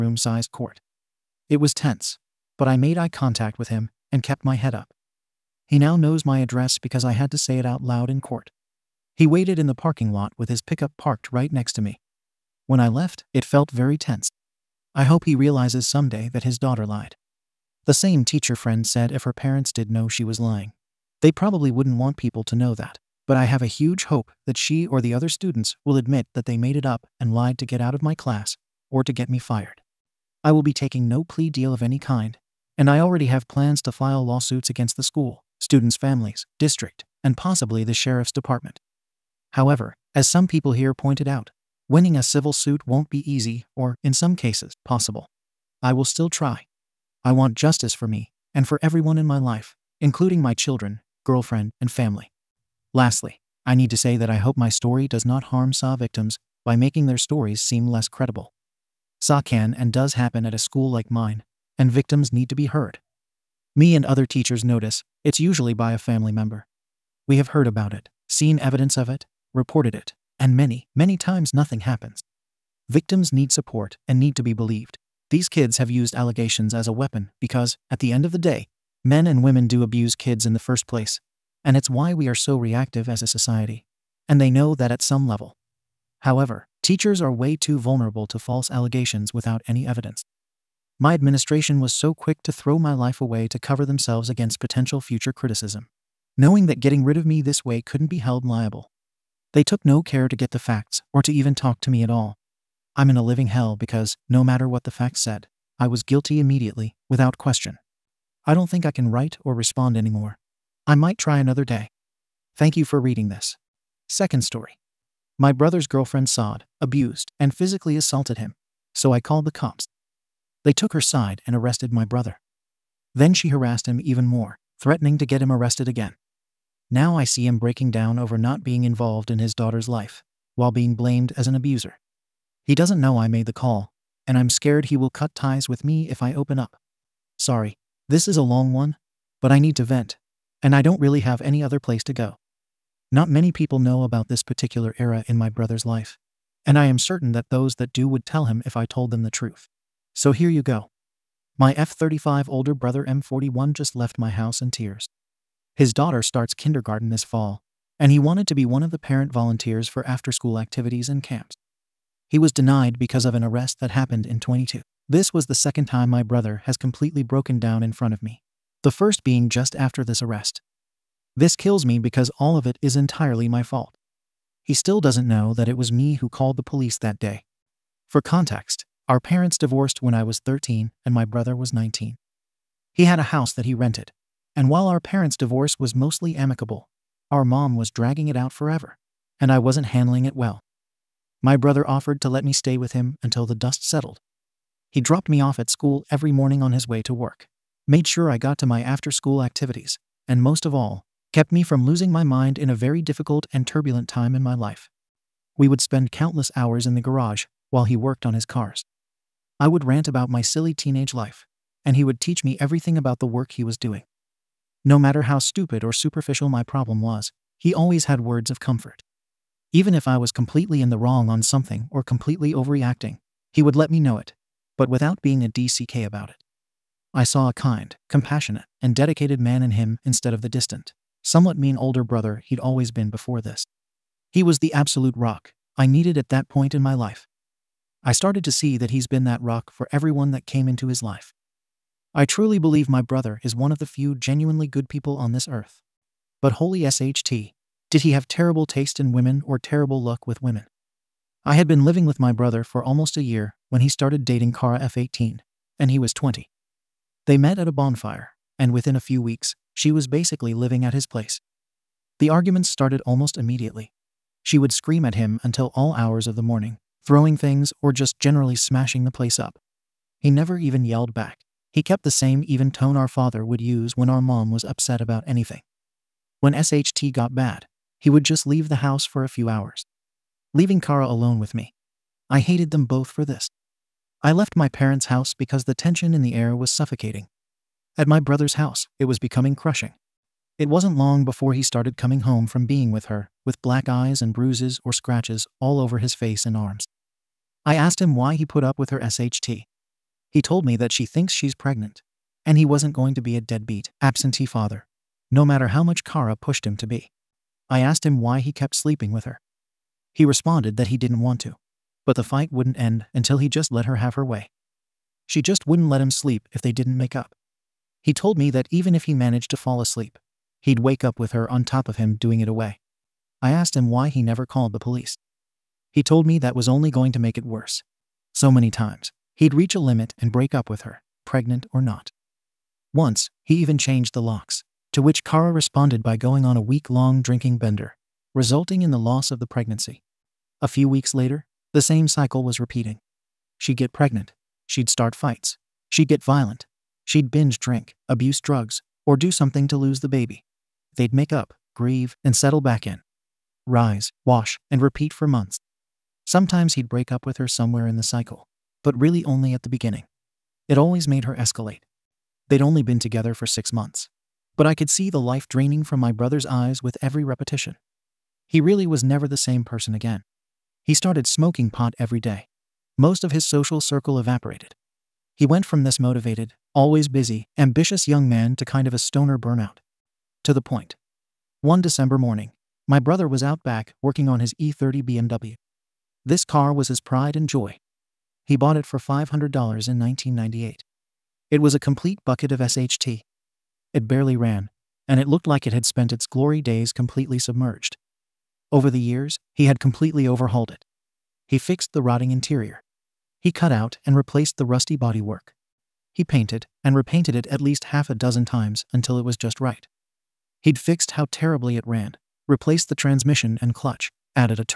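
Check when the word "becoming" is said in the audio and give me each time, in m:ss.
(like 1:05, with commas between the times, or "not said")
4:49.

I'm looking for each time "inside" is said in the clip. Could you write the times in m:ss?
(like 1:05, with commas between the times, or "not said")
not said.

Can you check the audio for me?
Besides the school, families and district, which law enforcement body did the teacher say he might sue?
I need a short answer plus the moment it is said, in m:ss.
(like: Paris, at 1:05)
the sheriff's department, at 0:37.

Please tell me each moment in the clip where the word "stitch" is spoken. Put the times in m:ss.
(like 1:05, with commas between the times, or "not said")
not said.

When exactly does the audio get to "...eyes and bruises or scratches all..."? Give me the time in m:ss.
4:53.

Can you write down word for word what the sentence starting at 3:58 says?
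I started to see that he's been that rock for everyone that came into his life.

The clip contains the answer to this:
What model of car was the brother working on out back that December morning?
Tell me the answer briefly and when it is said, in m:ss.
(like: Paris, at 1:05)
E30 BMW, at 6:24.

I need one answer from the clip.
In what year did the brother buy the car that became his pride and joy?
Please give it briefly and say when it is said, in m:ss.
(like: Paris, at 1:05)
1998, at 6:29.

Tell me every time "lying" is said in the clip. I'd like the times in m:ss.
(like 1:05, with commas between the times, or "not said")
0:20.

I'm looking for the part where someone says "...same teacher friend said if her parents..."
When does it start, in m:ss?
0:17.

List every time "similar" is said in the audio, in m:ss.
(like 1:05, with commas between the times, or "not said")
not said.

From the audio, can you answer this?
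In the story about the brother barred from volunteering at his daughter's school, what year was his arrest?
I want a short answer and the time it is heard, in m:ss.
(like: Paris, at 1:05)
2022, at 2:44.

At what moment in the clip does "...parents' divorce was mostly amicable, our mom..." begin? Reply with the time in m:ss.
3:05.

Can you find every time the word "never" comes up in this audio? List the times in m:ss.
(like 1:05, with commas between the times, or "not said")
4:30, 5:24, 6:09.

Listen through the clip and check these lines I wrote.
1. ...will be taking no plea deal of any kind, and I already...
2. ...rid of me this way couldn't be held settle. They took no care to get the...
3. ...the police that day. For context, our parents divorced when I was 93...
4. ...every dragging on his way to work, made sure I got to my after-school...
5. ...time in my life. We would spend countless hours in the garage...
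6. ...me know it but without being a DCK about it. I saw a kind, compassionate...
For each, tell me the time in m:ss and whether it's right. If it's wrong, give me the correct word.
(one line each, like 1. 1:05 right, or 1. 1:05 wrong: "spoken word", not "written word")
1. 0:30 right
2. 1:37 wrong: "liable", not "settle"
3. 2:56 wrong: "13", not "93"
4. 3:16 wrong: "morning", not "dragging"
5. 3:24 right
6. 3:43 right.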